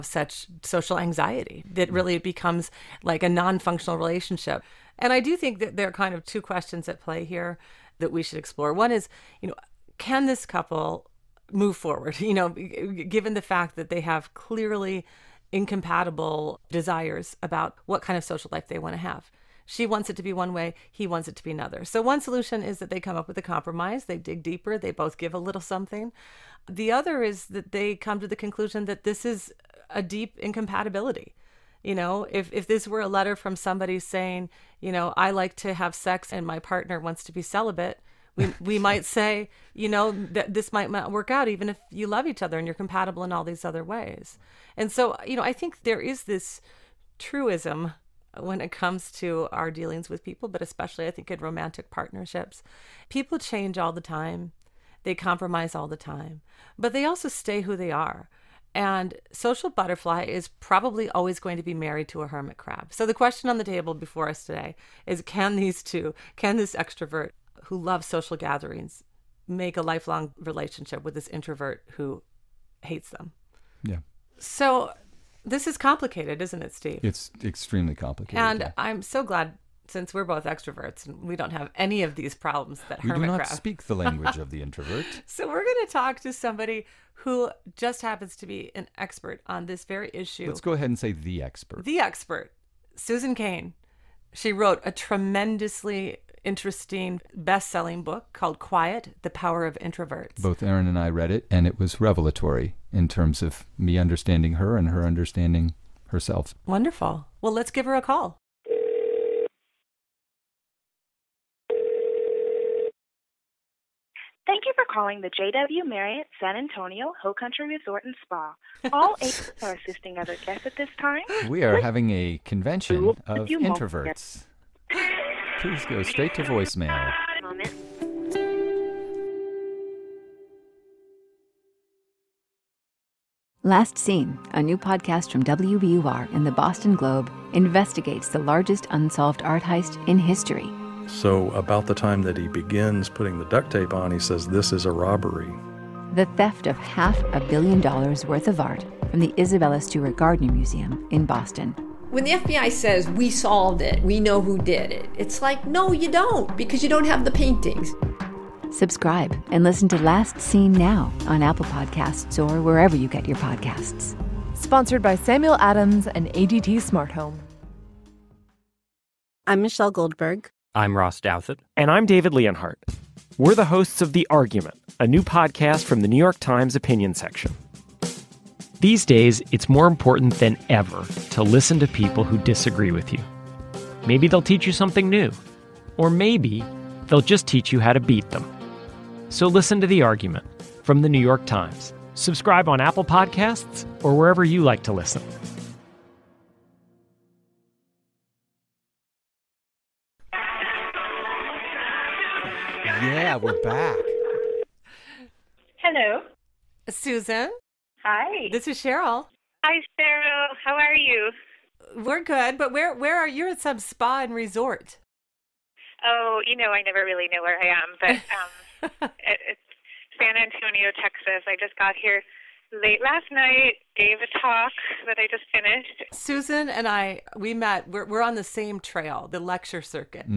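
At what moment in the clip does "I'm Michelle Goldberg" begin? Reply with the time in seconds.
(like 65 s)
169 s.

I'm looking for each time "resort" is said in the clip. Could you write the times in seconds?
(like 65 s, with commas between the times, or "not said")
117 s, 214 s.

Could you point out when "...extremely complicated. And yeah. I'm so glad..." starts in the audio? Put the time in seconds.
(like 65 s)
77 s.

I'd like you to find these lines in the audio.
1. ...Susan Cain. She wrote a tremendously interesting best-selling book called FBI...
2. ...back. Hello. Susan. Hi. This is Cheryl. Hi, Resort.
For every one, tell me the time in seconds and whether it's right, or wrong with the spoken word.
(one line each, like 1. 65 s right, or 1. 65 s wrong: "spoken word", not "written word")
1. 92 s wrong: "Quiet", not "FBI"
2. 203 s wrong: "Cheryl", not "Resort".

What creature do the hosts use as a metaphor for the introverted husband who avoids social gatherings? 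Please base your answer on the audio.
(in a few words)
Hermit crab.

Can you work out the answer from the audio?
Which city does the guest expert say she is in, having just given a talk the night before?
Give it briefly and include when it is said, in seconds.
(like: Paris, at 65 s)
San Antonio, Texas, at 220 s.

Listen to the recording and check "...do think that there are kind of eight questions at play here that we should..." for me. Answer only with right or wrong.
wrong.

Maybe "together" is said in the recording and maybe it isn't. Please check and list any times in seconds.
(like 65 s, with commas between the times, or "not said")
not said.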